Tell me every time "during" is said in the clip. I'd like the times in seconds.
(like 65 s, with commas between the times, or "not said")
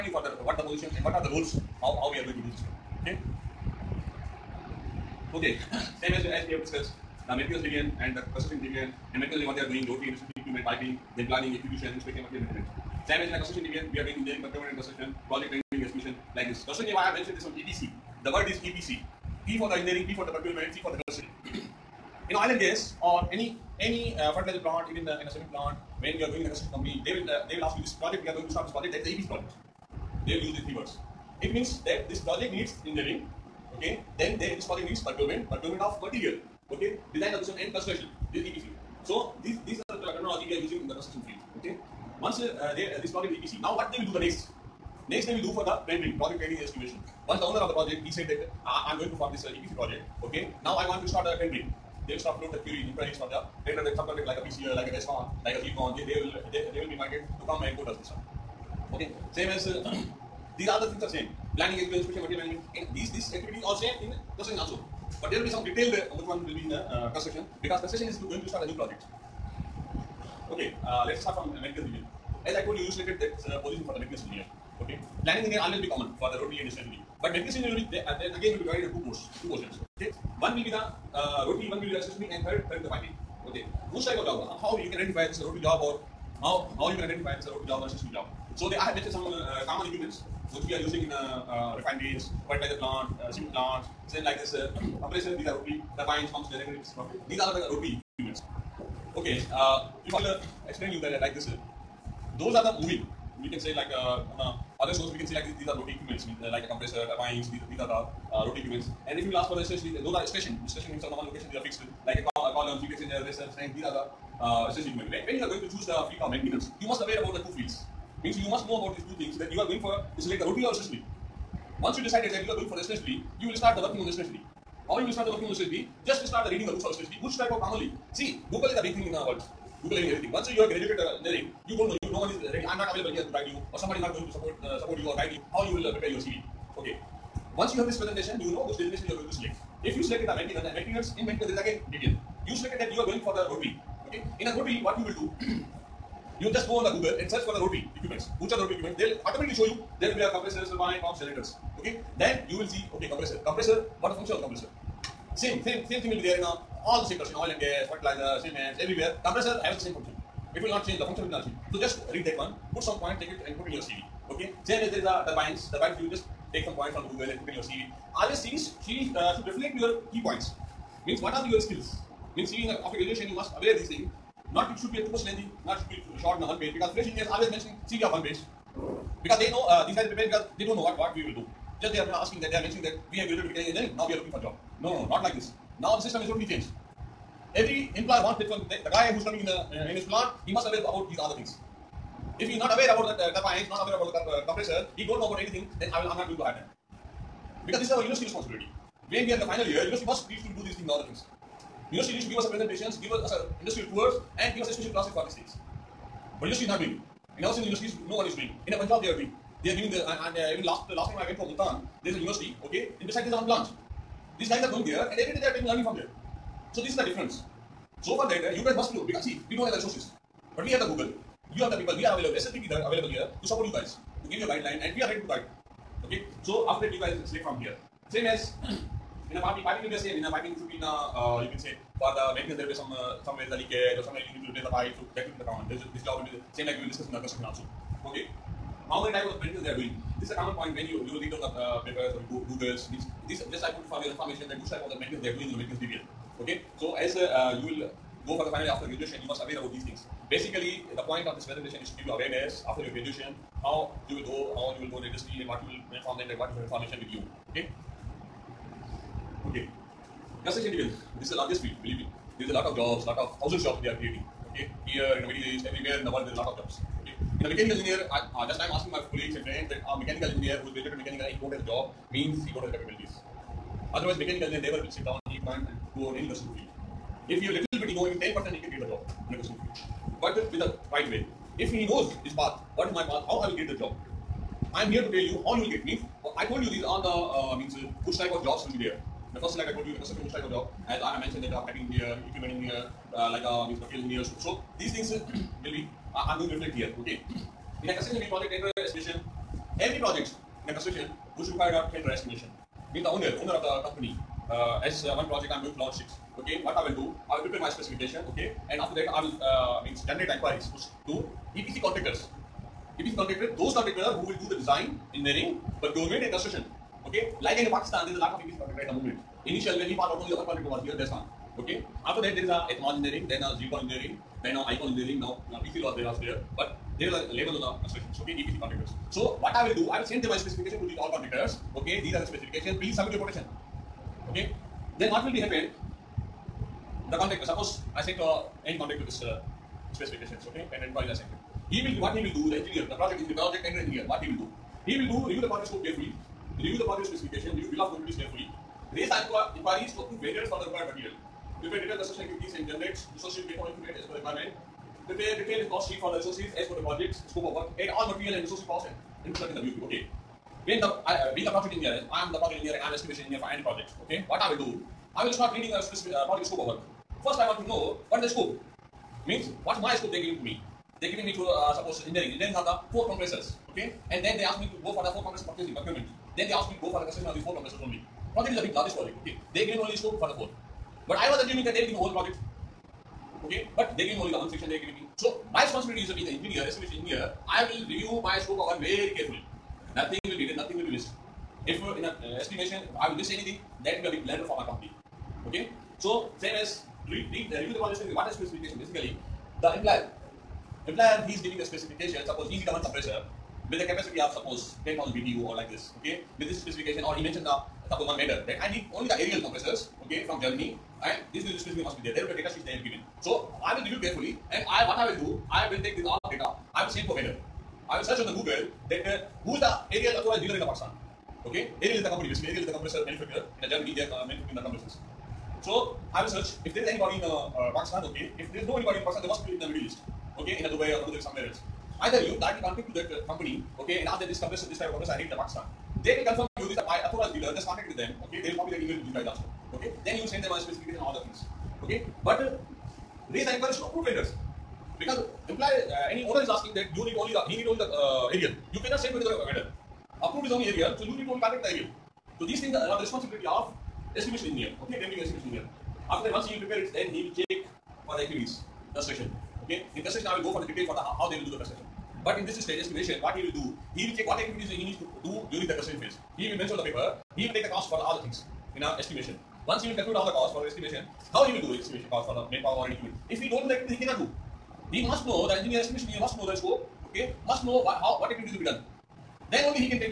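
465 s.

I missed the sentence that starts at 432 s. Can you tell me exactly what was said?
Either you directly contact to that uh, company.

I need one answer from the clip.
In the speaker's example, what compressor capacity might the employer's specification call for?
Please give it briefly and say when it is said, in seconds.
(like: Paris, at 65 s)
10,000 BTU, at 404 s.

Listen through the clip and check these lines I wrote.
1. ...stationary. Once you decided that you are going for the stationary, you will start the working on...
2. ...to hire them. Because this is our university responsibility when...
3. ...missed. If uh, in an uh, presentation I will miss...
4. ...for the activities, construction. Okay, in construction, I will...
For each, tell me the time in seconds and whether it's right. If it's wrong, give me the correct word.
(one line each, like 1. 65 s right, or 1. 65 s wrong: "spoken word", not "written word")
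1. 120 s right
2. 196 s right
3. 390 s wrong: "estimation", not "presentation"
4. 458 s right.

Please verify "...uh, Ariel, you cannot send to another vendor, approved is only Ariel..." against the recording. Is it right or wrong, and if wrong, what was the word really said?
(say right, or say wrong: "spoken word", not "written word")
right.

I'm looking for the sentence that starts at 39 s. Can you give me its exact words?
So these, these are the terminology we are using in the construction field, okay.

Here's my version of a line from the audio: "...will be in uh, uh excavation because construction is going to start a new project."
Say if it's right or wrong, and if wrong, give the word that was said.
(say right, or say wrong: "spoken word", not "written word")
wrong: "construction", not "excavation".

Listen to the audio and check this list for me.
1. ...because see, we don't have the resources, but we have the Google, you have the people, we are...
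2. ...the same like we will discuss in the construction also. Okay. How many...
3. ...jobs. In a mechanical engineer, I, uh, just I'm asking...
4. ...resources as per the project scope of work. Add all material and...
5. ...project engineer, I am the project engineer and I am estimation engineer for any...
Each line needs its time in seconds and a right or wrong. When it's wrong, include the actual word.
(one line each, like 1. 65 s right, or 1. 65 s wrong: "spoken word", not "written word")
1. 219 s right
2. 236 s right
3. 266 s right
4. 356 s right
5. 361 s right.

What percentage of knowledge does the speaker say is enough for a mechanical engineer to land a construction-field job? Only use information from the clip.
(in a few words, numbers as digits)
10%.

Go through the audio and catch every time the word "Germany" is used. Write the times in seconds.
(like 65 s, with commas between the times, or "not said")
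410 s, 423 s.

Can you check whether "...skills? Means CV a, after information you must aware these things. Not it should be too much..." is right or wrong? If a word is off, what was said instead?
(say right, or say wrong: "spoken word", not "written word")
wrong: "graduation", not "information".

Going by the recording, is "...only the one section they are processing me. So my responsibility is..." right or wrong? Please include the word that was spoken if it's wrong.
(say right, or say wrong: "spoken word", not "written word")
wrong: "giving", not "processing".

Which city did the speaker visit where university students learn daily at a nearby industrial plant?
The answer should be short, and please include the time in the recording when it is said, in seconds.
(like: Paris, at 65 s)
Multan, at 211 s.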